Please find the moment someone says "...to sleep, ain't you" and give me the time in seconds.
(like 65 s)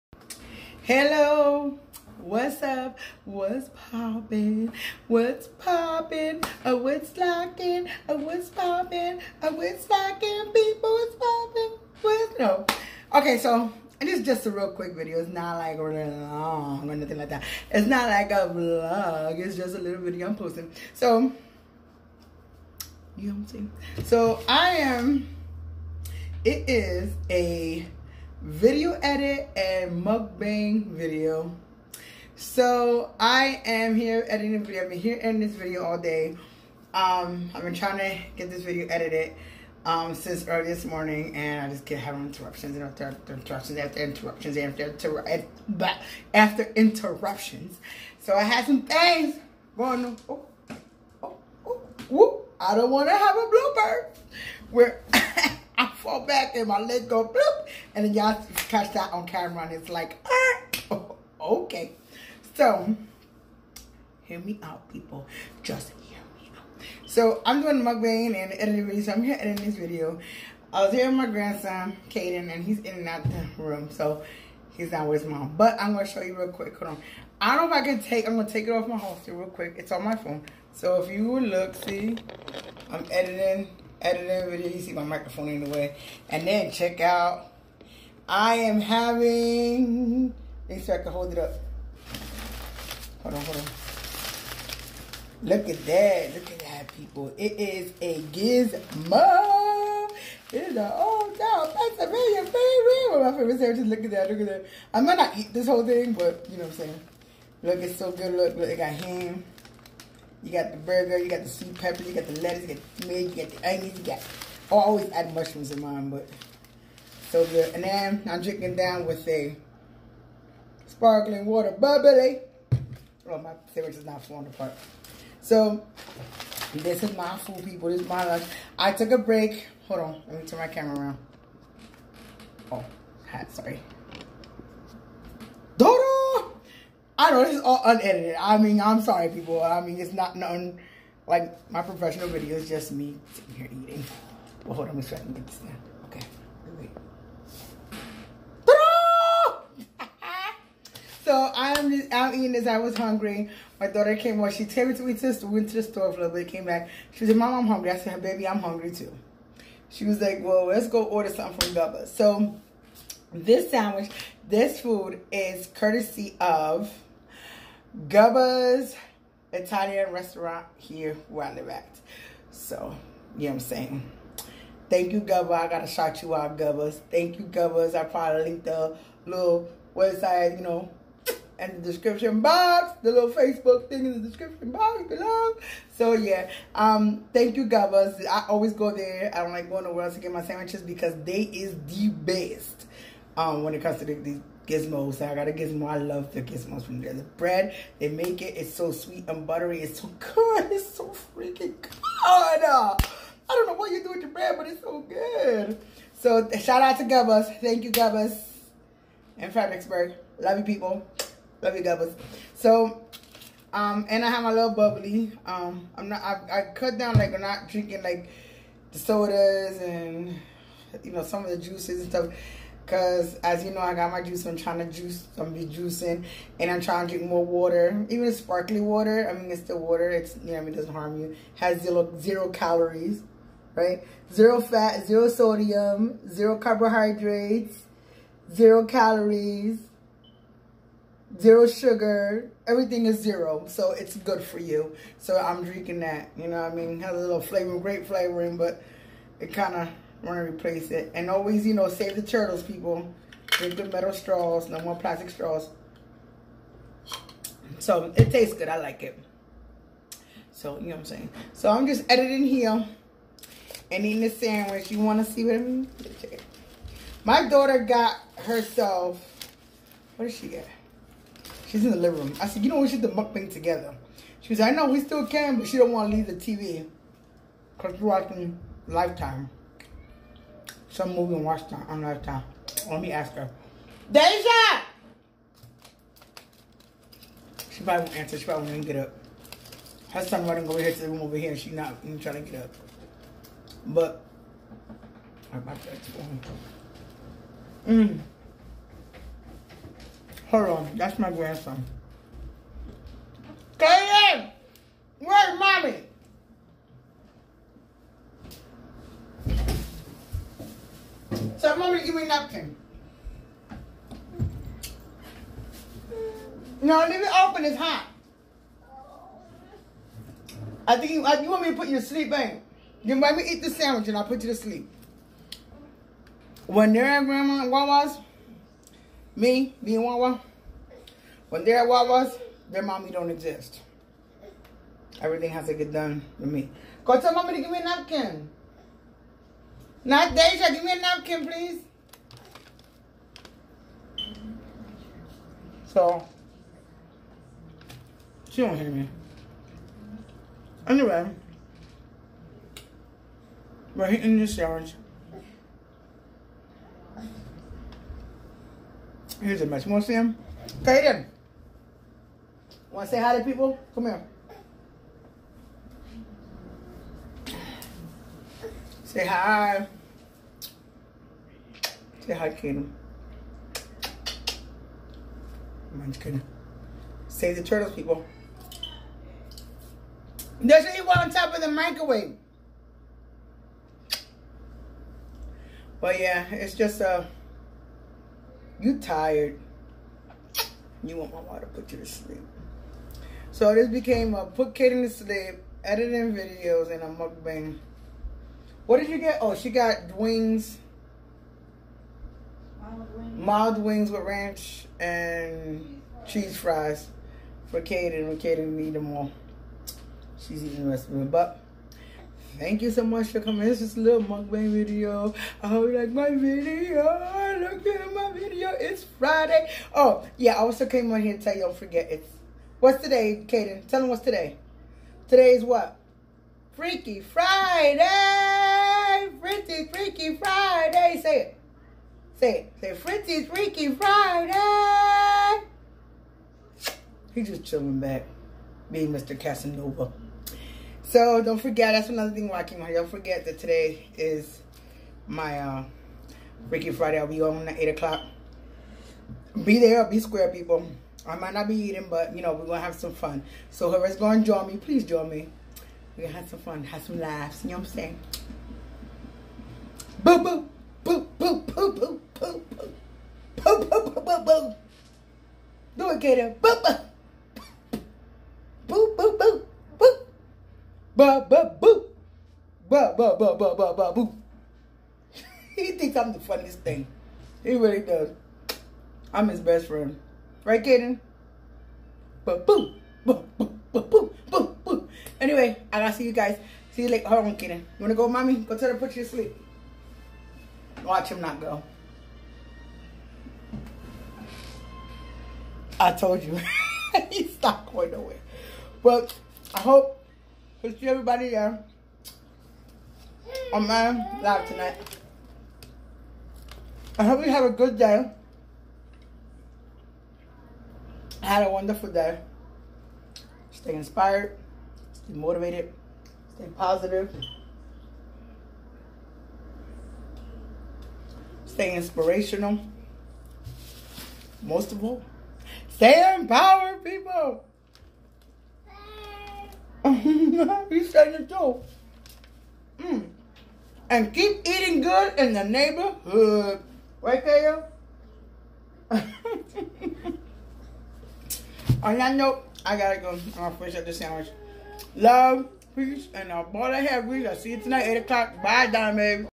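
321 s.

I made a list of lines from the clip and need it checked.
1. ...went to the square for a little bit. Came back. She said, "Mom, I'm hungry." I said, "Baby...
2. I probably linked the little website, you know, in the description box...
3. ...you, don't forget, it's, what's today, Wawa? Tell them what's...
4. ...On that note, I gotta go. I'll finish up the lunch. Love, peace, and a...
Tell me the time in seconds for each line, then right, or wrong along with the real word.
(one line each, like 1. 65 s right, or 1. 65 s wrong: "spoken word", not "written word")
1. 155 s wrong: "store", not "square"
2. 177 s right
3. 421 s wrong: "Kaden", not "Wawa"
4. 539 s wrong: "sandwich", not "lunch".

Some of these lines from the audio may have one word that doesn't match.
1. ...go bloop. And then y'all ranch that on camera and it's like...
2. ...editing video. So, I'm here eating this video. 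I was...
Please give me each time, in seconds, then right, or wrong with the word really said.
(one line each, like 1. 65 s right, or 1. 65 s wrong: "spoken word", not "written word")
1. 57 s wrong: "catch", not "ranch"
2. 68 s wrong: "editing", not "eating".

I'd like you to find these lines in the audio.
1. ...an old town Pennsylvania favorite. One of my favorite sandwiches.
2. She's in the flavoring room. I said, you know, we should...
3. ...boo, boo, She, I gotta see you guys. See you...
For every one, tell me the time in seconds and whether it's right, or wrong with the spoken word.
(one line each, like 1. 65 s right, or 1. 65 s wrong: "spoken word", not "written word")
1. 100 s right
2. 271 s wrong: "living", not "flavoring"
3. 484 s wrong: "Anyway", not "She".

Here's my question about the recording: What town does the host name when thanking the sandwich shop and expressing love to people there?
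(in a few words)
Fredericksburg.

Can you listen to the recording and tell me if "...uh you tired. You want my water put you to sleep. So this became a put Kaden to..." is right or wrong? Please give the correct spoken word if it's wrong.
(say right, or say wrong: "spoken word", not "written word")
right.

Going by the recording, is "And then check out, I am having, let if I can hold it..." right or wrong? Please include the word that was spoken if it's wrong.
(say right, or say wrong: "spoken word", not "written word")
right.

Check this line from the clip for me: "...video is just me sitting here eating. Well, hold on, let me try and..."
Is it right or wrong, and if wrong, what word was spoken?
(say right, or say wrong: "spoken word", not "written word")
right.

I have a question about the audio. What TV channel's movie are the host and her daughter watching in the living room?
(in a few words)
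Lifetime.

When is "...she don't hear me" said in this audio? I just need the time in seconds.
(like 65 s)
348 s.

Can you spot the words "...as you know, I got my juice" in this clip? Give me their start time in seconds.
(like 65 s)
223 s.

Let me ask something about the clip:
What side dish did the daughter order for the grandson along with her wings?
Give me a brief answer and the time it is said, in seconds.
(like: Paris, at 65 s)
Cheese fries, at 406 s.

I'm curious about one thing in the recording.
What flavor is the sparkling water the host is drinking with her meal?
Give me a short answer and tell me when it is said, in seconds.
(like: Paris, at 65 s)
Grape, at 247 s.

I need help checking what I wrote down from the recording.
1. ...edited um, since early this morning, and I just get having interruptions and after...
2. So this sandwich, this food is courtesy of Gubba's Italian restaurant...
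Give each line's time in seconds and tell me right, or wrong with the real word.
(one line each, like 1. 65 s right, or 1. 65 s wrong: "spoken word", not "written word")
1. 38 s right
2. 162 s right.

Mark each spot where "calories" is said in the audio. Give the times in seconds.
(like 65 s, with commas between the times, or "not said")
232 s, 238 s.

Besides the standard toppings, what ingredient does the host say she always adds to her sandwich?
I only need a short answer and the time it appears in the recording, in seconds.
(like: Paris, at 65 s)
Mushrooms, at 114 s.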